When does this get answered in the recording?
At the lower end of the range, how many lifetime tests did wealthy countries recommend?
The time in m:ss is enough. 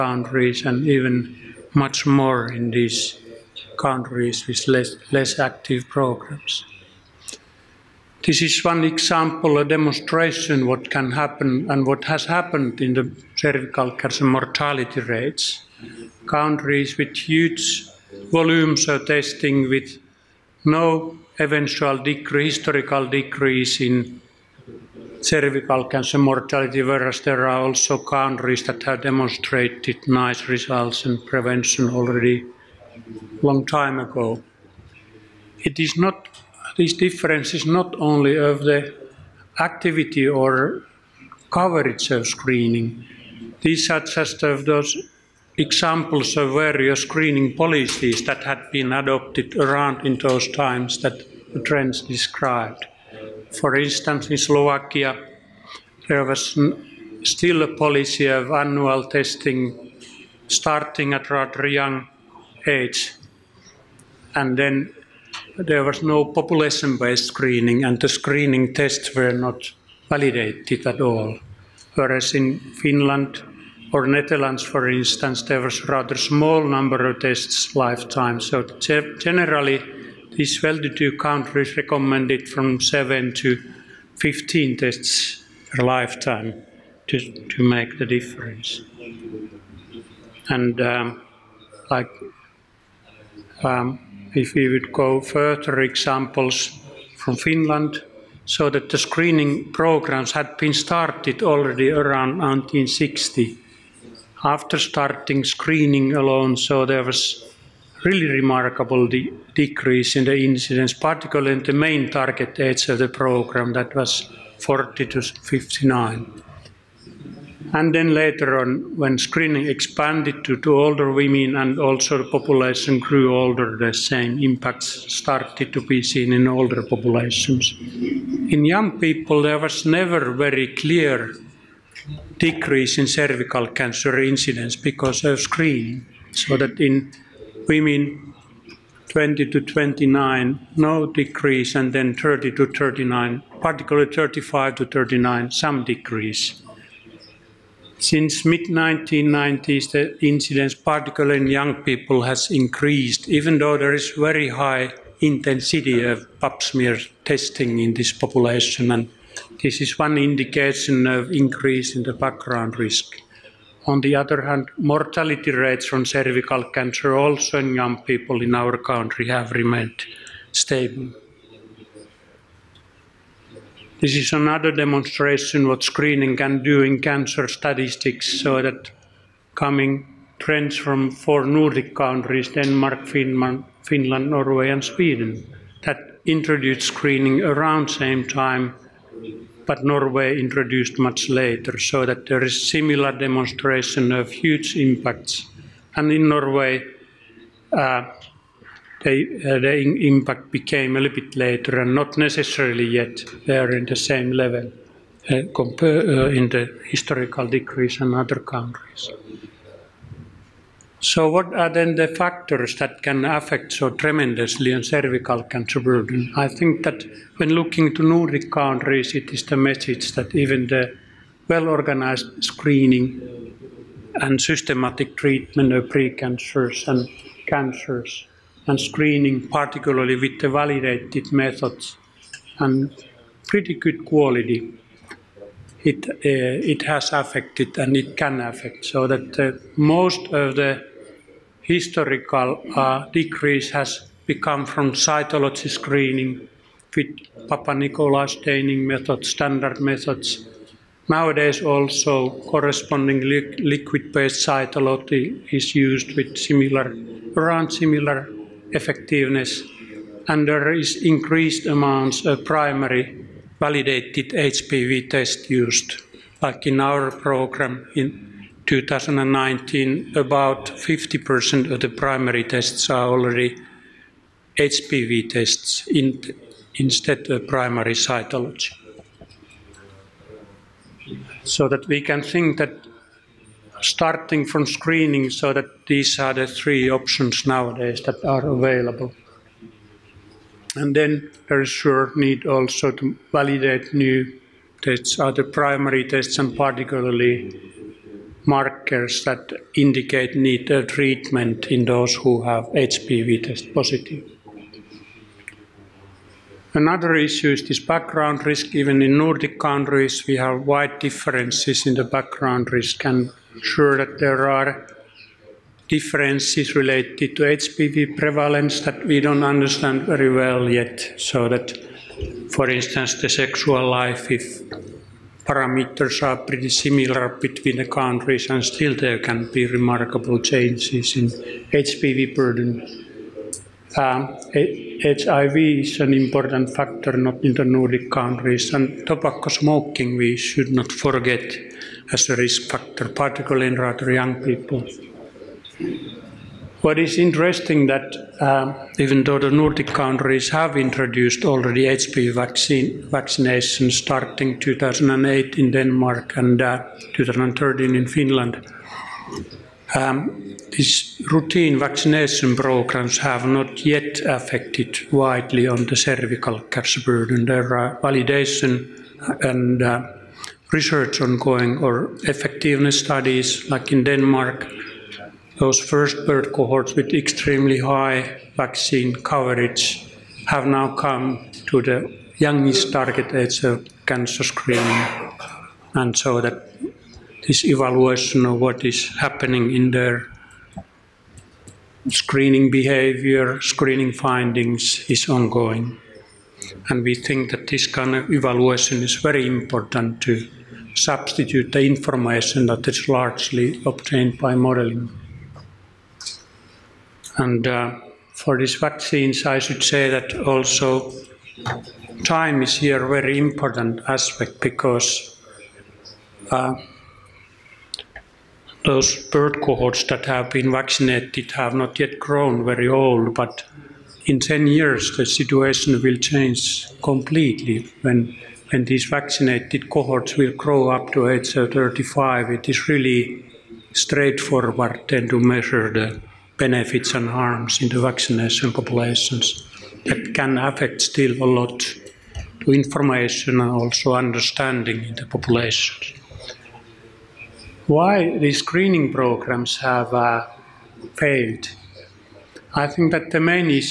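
1:22.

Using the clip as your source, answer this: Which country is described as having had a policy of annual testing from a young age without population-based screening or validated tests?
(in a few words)
Slovakia.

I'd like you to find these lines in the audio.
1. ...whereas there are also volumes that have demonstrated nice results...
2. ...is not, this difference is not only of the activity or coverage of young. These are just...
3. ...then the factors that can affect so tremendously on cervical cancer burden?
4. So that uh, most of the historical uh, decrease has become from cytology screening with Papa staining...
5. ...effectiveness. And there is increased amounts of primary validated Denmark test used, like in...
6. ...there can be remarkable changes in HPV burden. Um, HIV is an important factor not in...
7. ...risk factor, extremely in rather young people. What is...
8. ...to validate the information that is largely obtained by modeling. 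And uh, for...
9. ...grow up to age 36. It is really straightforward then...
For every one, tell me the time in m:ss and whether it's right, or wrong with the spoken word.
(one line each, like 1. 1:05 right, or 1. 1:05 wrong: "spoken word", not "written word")
1. 0:26 wrong: "countries", not "volumes"
2. 0:35 wrong: "screening", not "young"
3. 3:31 right
4. 3:58 right
5. 4:18 wrong: "HPV", not "Denmark"
6. 5:28 right
7. 5:42 wrong: "particularly", not "extremely"
8. 6:40 wrong: "substitute", not "validate"
9. 7:10 wrong: "35", not "36".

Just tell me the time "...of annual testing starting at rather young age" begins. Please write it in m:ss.
0:58.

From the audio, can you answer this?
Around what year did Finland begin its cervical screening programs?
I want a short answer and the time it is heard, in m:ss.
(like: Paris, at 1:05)
1960, at 1:42.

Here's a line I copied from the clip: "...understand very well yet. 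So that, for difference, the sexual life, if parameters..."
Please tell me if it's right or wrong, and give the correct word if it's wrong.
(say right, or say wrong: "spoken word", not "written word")
wrong: "instance", not "difference".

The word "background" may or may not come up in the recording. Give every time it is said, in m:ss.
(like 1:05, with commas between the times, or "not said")
2:42, 5:07, 5:12.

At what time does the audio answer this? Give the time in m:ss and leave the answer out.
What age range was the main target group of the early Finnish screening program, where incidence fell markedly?
1:54.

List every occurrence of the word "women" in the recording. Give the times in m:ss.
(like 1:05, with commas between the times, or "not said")
2:01, 2:17.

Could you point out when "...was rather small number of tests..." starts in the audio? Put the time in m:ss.
1:15.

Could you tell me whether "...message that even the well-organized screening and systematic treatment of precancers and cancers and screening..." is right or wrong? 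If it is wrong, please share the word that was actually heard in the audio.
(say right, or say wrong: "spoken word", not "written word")
right.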